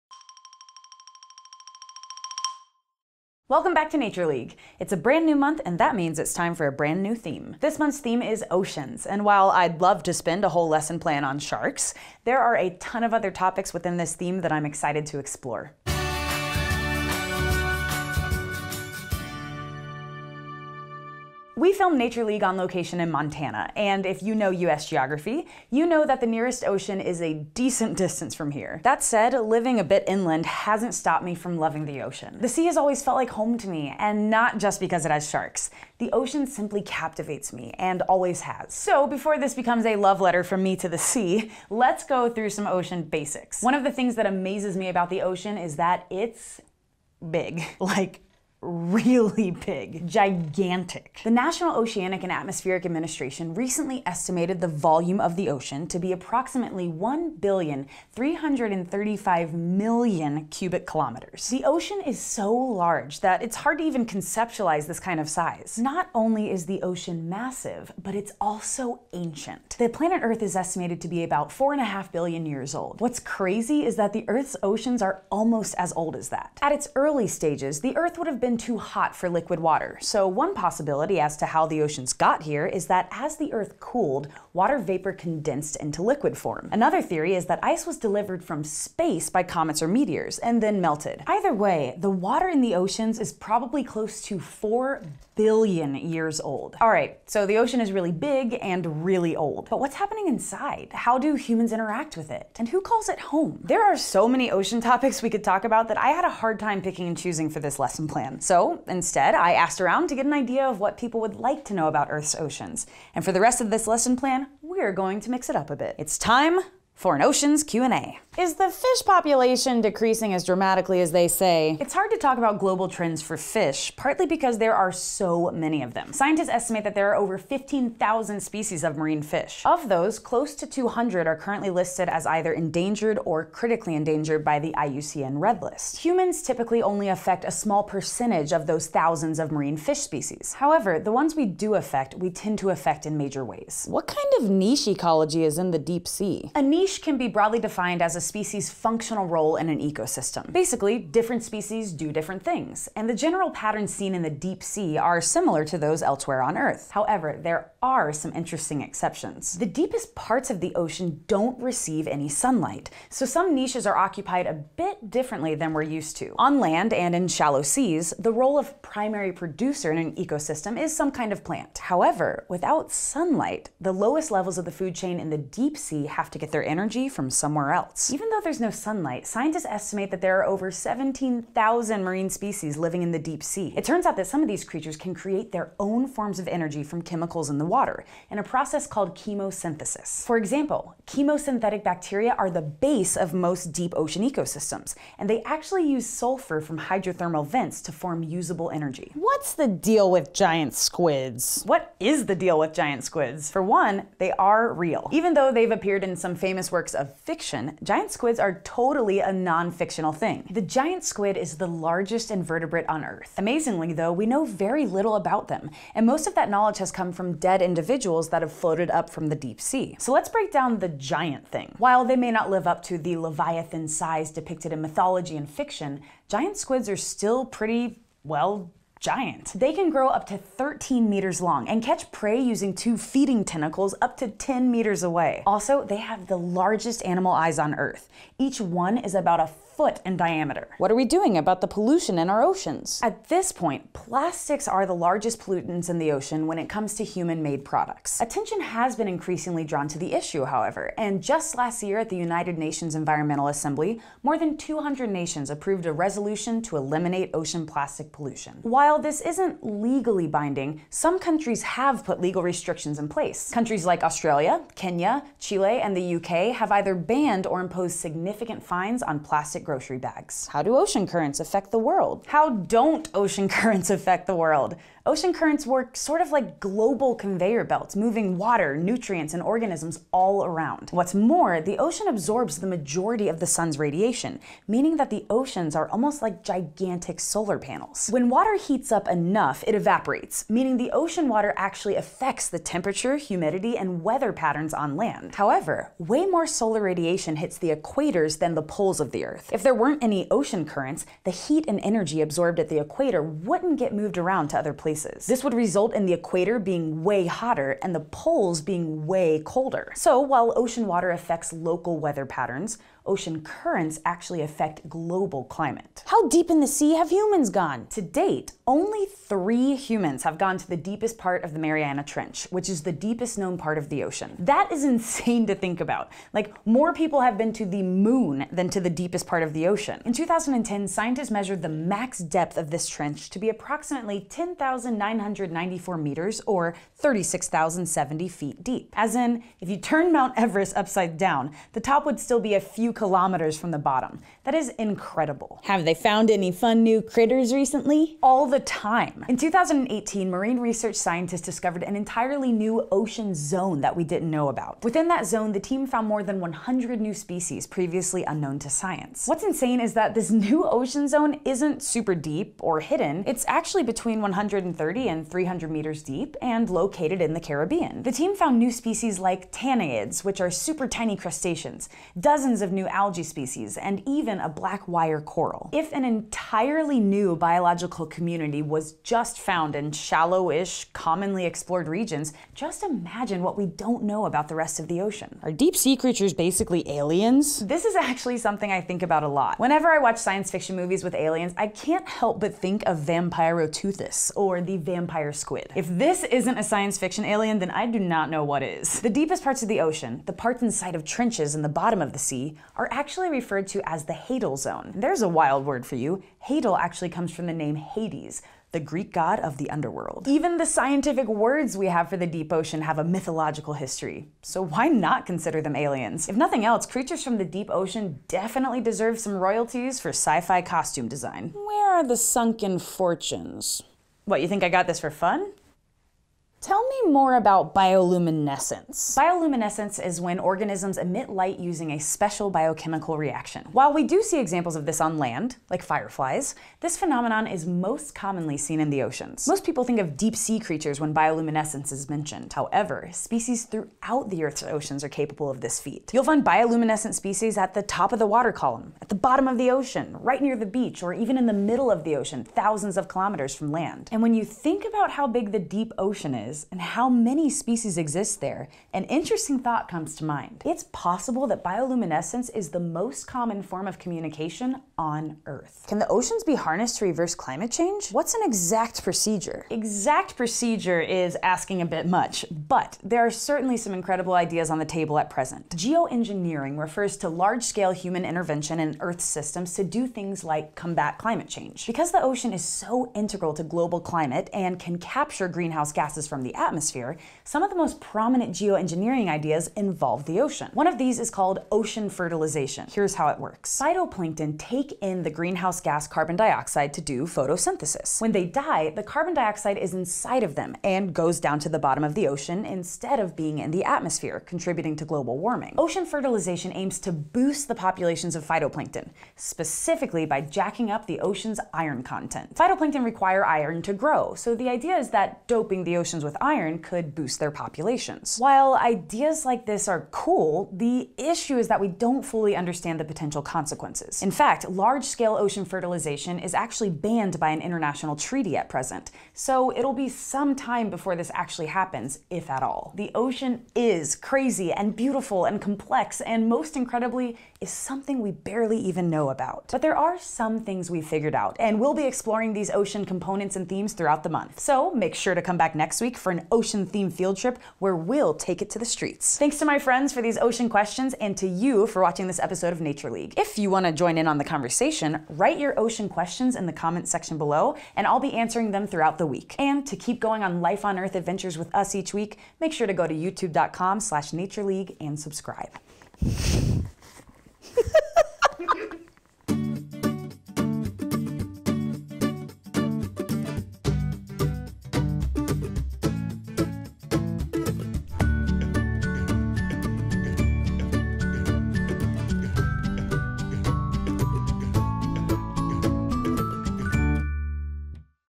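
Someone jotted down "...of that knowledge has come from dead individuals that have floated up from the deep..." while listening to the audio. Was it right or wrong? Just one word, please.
right.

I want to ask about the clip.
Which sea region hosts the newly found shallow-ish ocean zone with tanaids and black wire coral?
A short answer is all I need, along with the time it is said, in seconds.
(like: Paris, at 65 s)
the Caribbean, at 367 s.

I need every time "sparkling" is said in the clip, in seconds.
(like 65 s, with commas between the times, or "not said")
not said.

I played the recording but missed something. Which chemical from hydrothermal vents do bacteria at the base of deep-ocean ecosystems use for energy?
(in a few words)
sulfur.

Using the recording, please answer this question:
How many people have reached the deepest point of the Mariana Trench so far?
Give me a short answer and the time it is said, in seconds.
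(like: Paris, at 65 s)
3, at 319 s.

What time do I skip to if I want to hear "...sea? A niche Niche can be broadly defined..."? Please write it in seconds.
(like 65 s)
146 s.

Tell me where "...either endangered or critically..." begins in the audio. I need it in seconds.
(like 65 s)
132 s.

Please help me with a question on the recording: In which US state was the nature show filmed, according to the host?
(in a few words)
Montana.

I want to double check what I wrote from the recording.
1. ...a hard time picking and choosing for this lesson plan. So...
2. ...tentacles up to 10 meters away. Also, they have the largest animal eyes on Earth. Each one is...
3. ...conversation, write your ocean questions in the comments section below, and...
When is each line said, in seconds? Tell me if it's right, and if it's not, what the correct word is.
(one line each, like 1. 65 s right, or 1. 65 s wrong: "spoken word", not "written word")
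1. 106 s right
2. 233 s right
3. 554 s right.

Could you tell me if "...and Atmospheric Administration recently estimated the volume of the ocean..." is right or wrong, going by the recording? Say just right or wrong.
right.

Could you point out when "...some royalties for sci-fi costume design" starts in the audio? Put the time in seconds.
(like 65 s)
419 s.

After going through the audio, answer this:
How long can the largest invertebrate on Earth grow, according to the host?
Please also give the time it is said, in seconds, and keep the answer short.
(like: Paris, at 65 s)
13 meters, at 230 s.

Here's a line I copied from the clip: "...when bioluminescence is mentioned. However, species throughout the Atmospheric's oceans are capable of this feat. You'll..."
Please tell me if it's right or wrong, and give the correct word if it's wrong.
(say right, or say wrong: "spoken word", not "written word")
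wrong: "Earth", not "Atmospheric".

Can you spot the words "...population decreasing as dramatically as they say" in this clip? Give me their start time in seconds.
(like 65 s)
119 s.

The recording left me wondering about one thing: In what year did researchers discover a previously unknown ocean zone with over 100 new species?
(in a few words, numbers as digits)
2018.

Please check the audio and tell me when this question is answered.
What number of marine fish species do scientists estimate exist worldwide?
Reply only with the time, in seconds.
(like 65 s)
127 s.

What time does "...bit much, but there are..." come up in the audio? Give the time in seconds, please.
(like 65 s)
471 s.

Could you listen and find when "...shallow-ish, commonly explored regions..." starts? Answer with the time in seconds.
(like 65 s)
379 s.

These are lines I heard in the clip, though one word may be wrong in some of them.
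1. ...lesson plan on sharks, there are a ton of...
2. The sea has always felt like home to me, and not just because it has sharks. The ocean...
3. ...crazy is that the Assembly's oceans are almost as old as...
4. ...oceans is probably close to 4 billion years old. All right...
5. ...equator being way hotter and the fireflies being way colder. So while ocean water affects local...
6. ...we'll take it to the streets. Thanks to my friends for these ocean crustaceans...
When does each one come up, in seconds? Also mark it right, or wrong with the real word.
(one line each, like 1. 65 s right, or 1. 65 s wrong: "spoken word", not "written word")
1. 10 s right
2. 32 s right
3. 73 s wrong: "Earth", not "Assembly"
4. 92 s right
5. 306 s wrong: "poles", not "fireflies"
6. 547 s wrong: "questions", not "crustaceans".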